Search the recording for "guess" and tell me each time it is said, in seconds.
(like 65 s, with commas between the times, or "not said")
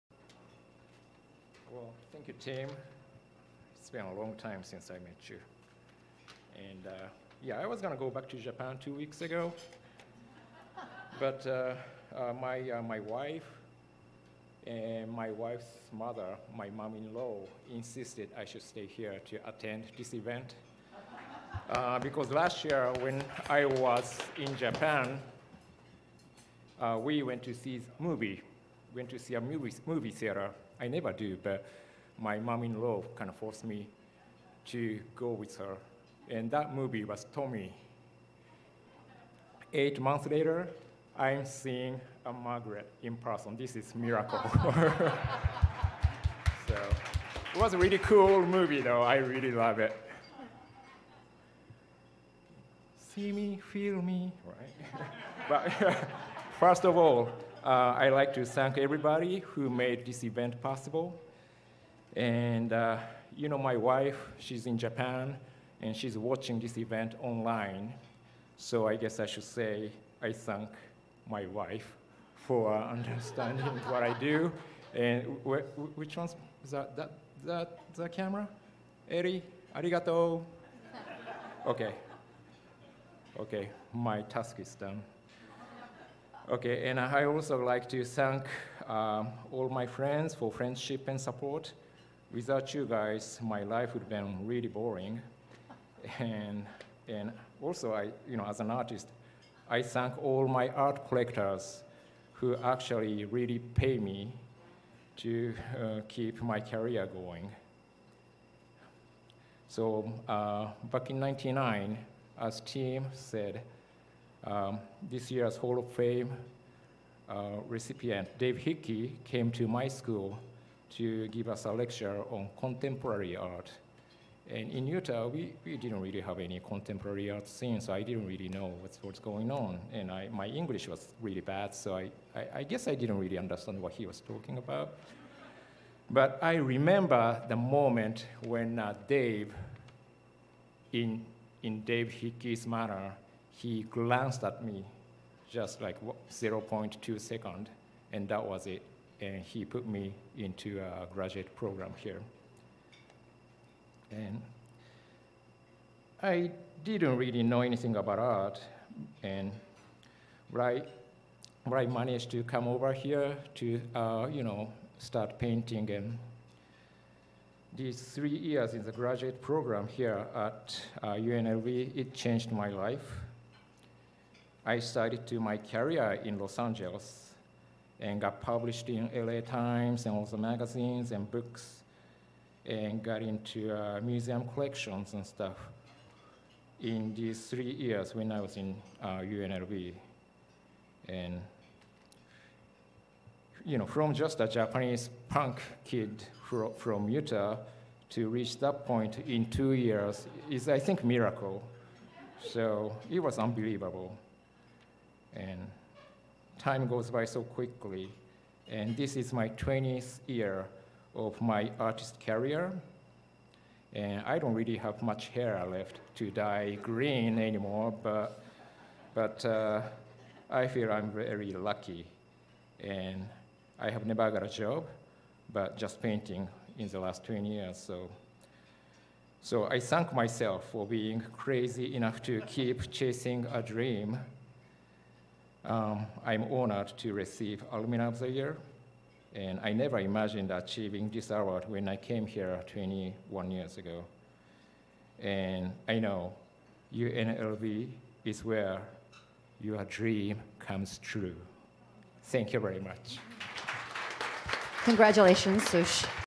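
68 s, 132 s.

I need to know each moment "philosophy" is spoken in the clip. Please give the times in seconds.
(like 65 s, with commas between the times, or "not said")
not said.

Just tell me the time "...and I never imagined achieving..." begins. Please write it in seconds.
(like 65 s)
239 s.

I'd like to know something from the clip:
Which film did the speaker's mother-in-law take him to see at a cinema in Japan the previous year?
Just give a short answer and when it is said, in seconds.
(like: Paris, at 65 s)
Tommy, at 37 s.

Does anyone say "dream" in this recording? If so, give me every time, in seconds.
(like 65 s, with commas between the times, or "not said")
233 s, 249 s.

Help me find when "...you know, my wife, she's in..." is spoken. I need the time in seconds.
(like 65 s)
63 s.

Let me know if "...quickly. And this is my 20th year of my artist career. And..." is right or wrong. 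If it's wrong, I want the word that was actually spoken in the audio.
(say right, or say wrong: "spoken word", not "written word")
right.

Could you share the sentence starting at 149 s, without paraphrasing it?
And he put me into a graduate program here.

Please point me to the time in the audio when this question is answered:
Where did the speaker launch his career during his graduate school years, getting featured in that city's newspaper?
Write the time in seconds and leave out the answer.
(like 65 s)
176 s.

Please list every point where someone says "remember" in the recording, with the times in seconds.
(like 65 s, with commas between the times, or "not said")
136 s.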